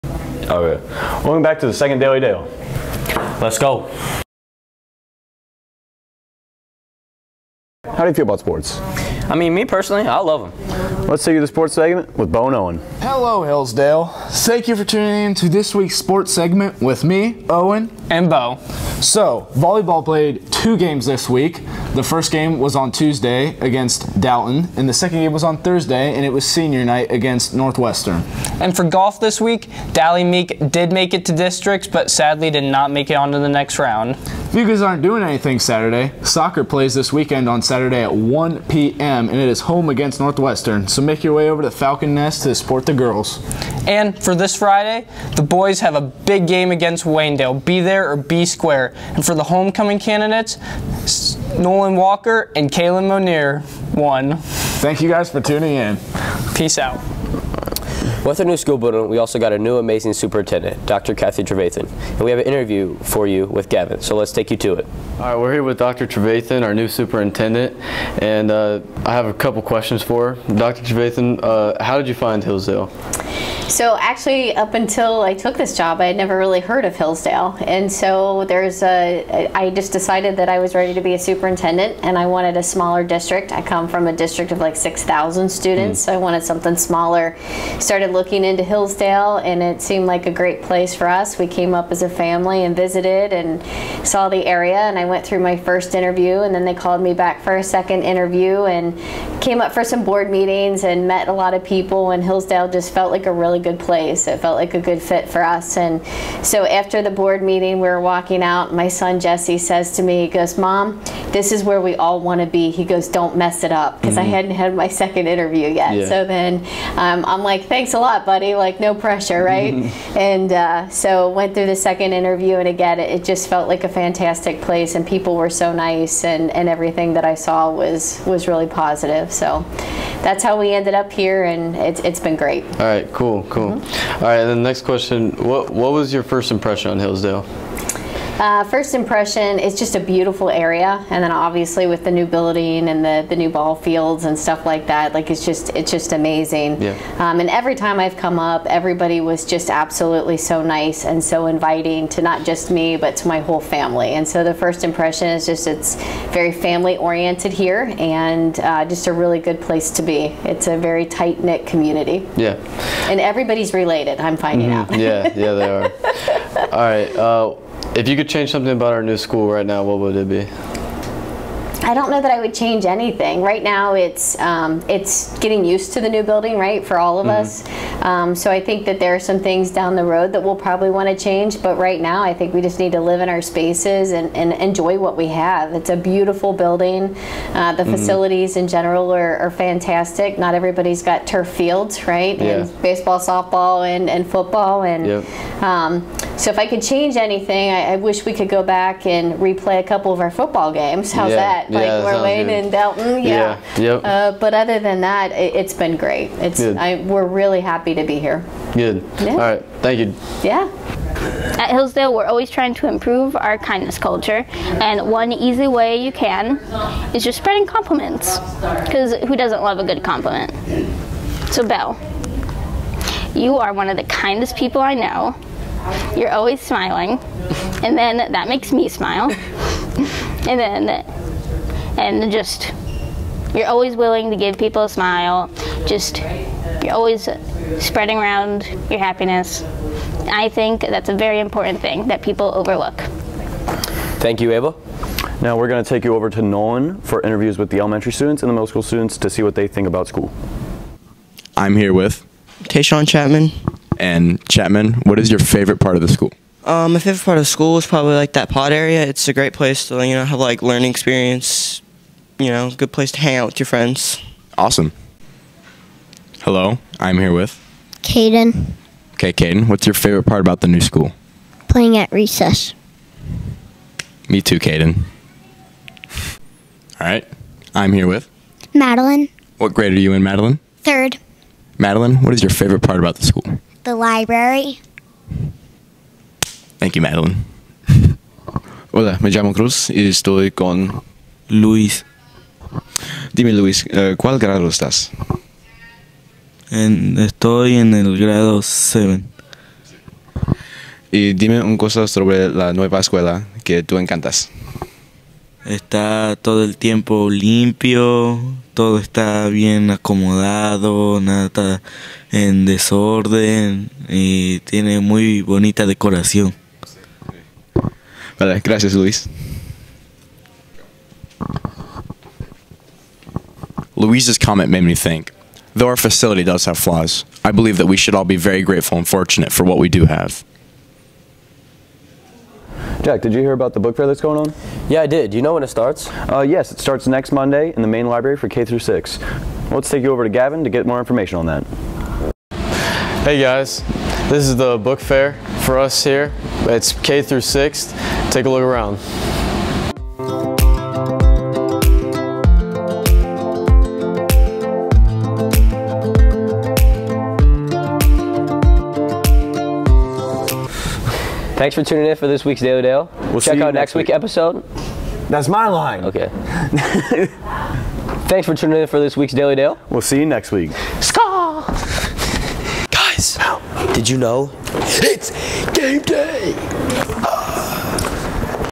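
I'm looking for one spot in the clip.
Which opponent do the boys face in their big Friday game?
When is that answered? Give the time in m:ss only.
0:47.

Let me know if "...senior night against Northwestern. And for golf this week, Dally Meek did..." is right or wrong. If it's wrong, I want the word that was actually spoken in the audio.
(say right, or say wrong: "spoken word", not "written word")
right.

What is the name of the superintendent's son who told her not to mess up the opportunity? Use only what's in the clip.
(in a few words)
Jesse.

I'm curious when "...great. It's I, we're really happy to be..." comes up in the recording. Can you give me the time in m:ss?
3:25.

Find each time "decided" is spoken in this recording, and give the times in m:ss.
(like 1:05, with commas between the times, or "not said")
1:19.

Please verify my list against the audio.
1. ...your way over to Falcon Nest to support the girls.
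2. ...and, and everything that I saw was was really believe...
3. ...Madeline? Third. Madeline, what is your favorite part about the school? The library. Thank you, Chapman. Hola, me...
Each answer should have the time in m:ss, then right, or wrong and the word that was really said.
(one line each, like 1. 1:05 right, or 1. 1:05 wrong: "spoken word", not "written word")
1. 0:41 right
2. 2:06 wrong: "positive", not "believe"
3. 4:40 wrong: "Madeline", not "Chapman".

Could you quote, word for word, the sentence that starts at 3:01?
But right now, I think we just need to live in our spaces and, and enjoy what we have.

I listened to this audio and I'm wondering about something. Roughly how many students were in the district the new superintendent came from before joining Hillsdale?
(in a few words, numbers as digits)
6,000.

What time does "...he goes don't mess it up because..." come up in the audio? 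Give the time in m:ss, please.
1:52.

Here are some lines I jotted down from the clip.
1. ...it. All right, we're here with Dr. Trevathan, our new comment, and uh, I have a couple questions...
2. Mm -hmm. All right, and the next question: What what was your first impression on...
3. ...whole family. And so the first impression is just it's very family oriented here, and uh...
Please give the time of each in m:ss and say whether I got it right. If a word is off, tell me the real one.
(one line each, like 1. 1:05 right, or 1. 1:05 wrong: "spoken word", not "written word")
1. 1:04 wrong: "superintendent", not "comment"
2. 2:13 right
3. 2:33 right.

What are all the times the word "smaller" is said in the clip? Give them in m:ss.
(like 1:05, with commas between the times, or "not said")
1:22, 1:26.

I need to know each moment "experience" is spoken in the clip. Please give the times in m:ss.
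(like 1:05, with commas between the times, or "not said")
4:20.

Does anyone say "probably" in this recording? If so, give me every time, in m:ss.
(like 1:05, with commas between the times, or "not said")
3:00, 4:17.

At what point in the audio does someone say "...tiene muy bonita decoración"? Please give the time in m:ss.
5:14.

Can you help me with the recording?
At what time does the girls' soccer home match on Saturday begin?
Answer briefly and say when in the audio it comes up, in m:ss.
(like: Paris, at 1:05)
1 p.m., at 0:38.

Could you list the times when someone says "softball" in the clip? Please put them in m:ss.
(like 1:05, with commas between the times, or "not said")
3:13.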